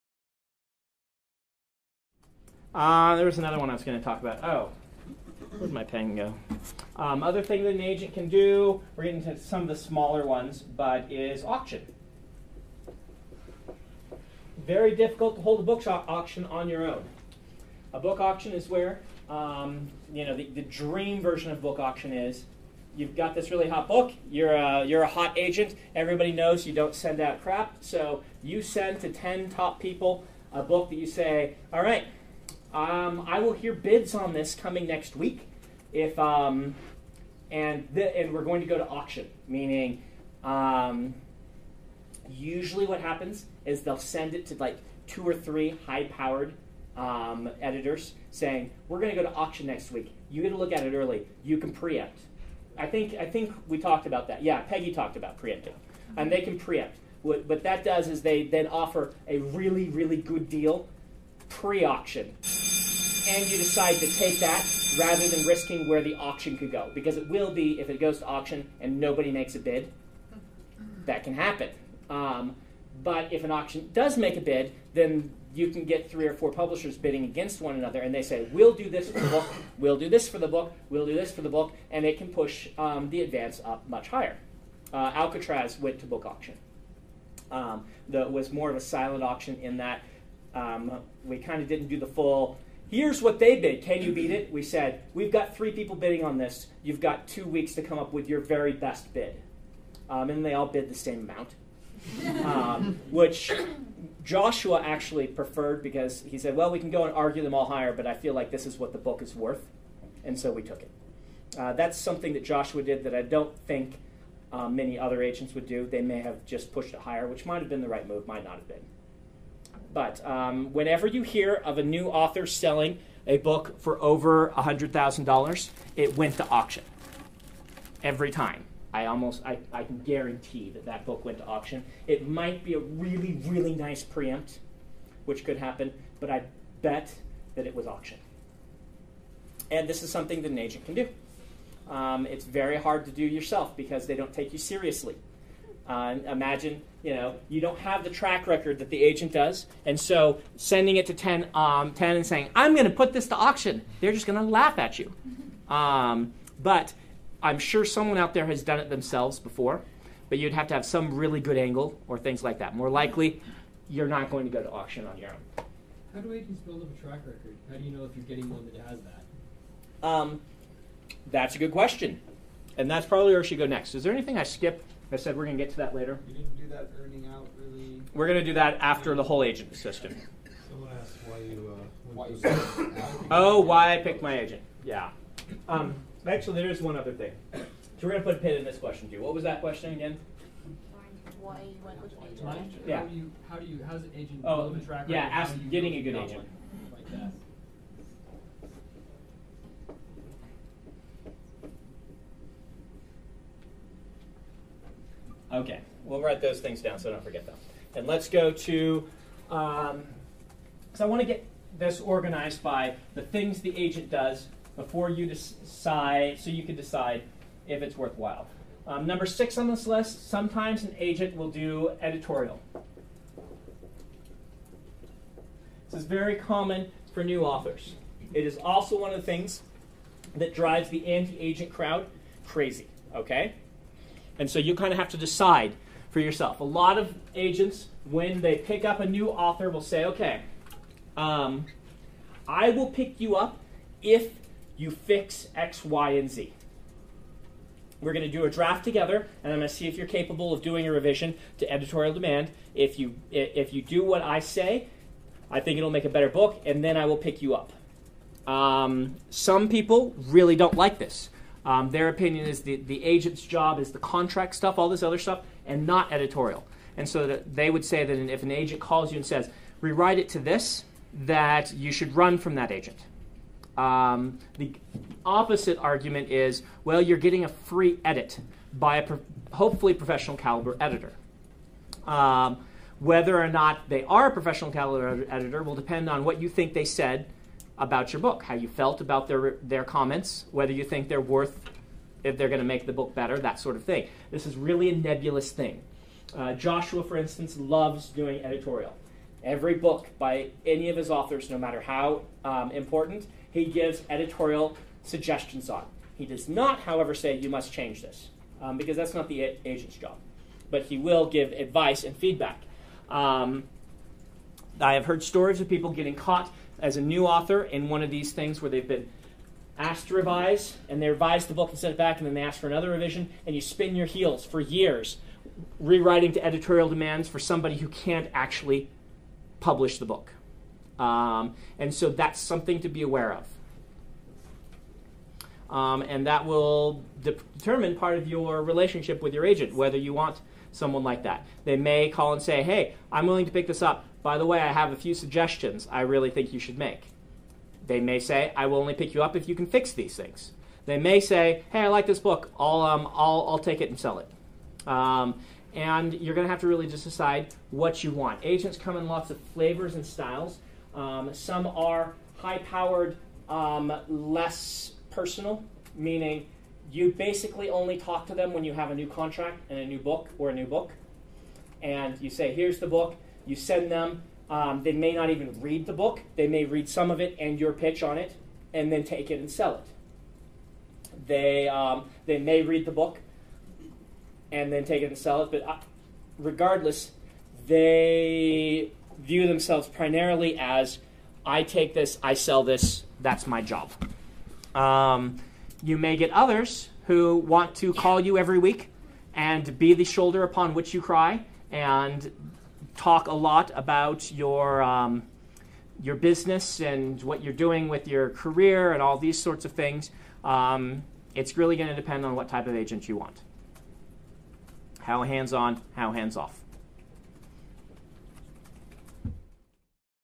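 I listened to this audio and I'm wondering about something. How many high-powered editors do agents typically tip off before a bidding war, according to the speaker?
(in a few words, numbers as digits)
2 or 3.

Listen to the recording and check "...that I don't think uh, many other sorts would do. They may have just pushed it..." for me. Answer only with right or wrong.
wrong.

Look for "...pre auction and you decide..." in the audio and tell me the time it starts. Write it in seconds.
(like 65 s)
61 s.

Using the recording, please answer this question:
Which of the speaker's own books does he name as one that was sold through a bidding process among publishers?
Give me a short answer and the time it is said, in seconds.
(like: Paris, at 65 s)
Alcatraz, at 85 s.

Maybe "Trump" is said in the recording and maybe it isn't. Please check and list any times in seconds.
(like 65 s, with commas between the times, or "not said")
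not said.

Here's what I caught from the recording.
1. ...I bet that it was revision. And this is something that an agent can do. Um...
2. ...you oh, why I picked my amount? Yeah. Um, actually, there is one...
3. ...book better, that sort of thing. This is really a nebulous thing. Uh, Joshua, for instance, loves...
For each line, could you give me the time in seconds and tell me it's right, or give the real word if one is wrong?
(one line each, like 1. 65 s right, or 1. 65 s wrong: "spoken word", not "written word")
1. 136 s wrong: "auction", not "revision"
2. 182 s wrong: "agent", not "amount"
3. 292 s right.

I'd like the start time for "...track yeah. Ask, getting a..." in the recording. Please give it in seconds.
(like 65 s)
194 s.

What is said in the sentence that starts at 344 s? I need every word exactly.
By the way, I have a few suggestions I really think you should make.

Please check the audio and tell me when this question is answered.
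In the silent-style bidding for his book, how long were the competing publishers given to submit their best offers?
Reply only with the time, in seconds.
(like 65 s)
97 s.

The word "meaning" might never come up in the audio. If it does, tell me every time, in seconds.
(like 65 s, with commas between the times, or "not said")
39 s, 365 s.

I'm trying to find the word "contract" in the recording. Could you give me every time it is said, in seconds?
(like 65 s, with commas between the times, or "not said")
263 s, 369 s.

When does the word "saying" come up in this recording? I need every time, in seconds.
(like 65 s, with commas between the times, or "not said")
48 s, 152 s.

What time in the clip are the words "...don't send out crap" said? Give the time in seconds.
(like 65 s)
26 s.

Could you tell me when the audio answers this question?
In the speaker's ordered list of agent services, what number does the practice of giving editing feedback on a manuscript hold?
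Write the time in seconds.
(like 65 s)
219 s.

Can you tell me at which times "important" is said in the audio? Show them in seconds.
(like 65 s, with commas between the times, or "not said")
302 s.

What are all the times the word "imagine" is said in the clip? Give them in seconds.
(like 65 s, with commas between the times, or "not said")
146 s.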